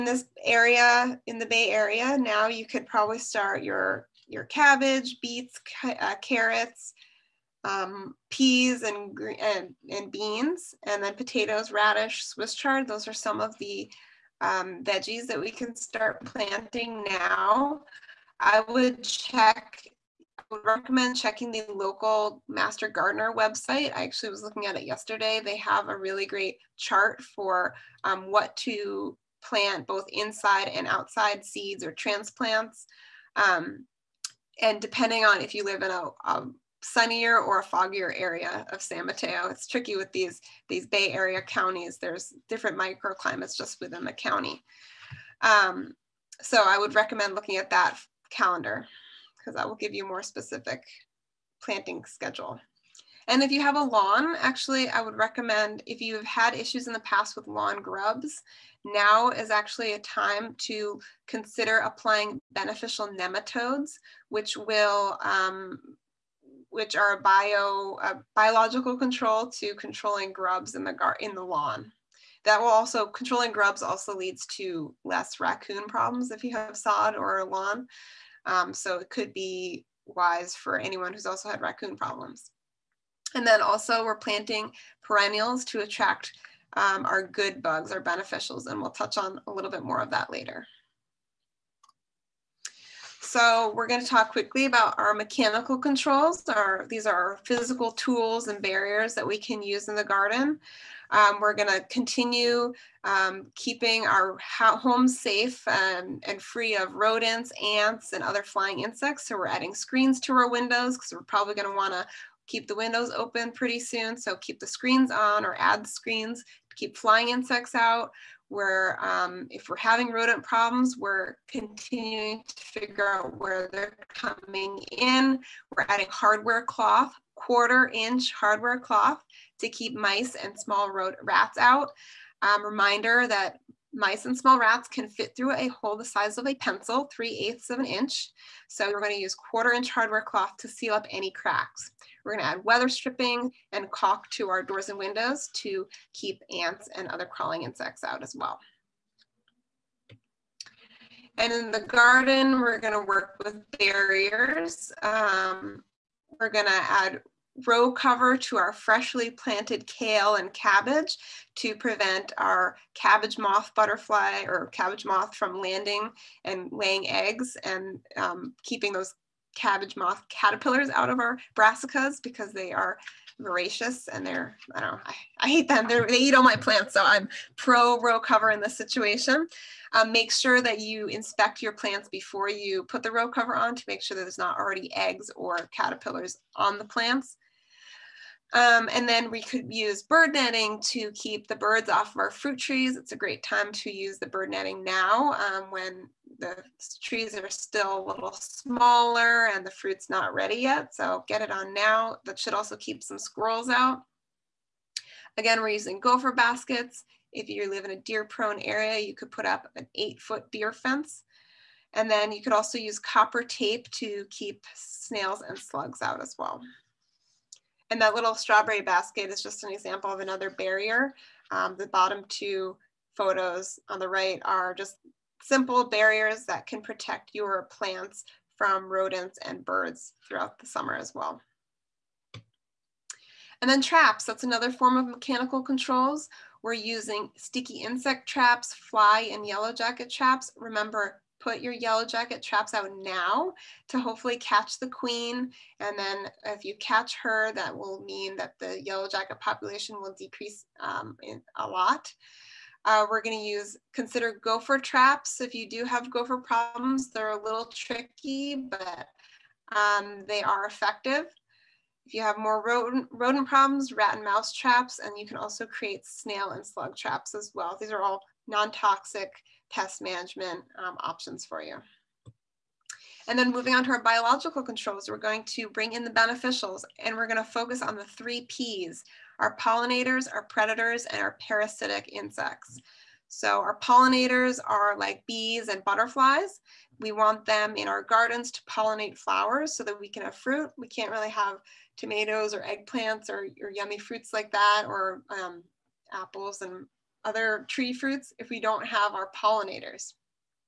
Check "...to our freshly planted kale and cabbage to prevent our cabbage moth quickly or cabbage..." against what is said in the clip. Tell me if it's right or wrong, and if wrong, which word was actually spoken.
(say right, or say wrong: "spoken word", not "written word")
wrong: "butterfly", not "quickly".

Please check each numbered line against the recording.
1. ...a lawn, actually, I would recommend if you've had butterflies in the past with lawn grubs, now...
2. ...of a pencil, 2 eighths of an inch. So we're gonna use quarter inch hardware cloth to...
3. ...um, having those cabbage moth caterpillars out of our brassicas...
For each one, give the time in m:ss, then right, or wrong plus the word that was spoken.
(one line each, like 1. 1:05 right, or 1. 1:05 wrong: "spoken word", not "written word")
1. 0:53 wrong: "issues", not "butterflies"
2. 2:16 wrong: "3", not "2"
3. 2:48 wrong: "keeping", not "having".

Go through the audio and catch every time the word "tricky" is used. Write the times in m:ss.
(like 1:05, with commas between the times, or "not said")
0:39, 4:17.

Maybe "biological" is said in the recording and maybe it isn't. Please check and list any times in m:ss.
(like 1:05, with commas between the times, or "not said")
1:08, 4:34.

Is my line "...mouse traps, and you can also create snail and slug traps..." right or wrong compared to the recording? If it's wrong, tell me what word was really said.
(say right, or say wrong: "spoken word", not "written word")
right.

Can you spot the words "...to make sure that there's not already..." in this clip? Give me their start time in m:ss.
3:03.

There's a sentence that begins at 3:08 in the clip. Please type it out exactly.
Um, and then we could use bird netting to keep the birds off of our fruit trees.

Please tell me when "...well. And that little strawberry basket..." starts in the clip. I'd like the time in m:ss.
3:36.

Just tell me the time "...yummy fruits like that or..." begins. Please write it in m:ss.
4:53.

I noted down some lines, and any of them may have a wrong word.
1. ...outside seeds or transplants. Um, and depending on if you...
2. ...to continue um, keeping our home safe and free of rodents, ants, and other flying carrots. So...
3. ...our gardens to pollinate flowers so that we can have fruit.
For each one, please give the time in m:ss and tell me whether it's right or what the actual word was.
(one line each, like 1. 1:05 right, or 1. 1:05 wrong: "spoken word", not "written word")
1. 0:30 right
2. 1:41 wrong: "insects", not "carrots"
3. 4:47 right.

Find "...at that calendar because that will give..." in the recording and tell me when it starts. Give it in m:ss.
0:47.